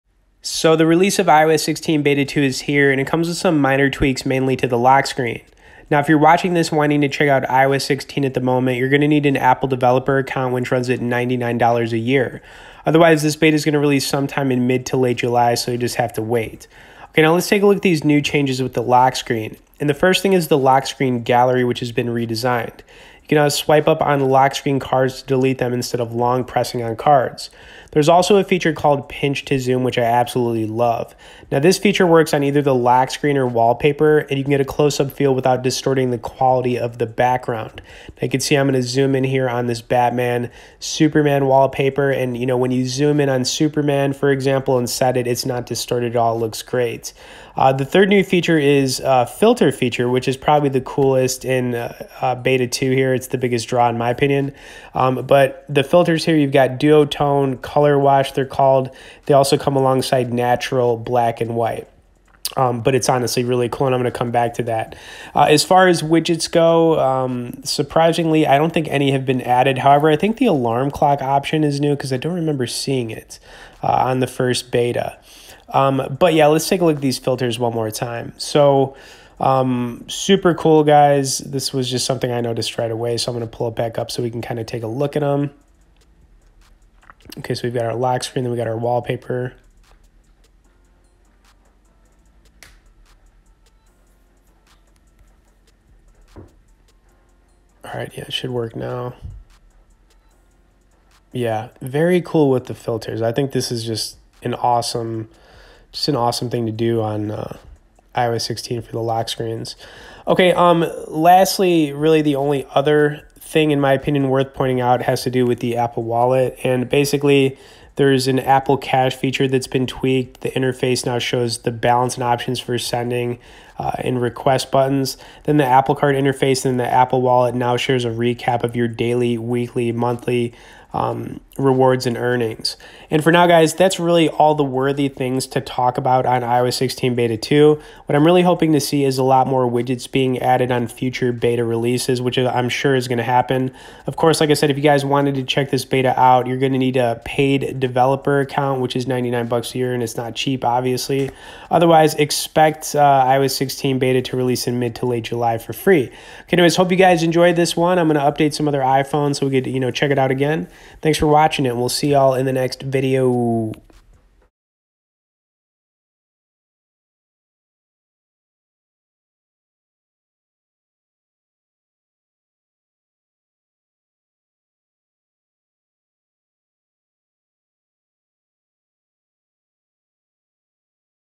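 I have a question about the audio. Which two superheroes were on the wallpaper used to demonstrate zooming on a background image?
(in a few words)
Batman, Superman.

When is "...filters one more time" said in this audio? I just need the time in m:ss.
1:17.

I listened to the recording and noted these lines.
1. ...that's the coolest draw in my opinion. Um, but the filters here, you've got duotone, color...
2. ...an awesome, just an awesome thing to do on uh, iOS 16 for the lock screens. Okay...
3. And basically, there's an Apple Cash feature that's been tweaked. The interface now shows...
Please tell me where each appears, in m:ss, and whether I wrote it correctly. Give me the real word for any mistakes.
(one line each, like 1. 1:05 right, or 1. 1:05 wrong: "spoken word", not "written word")
1. 0:53 wrong: "biggest", not "coolest"
2. 1:44 right
3. 1:56 right.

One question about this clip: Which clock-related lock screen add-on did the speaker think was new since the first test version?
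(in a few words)
Alarm clock.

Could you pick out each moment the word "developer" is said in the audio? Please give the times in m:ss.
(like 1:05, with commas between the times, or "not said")
0:09, 2:27.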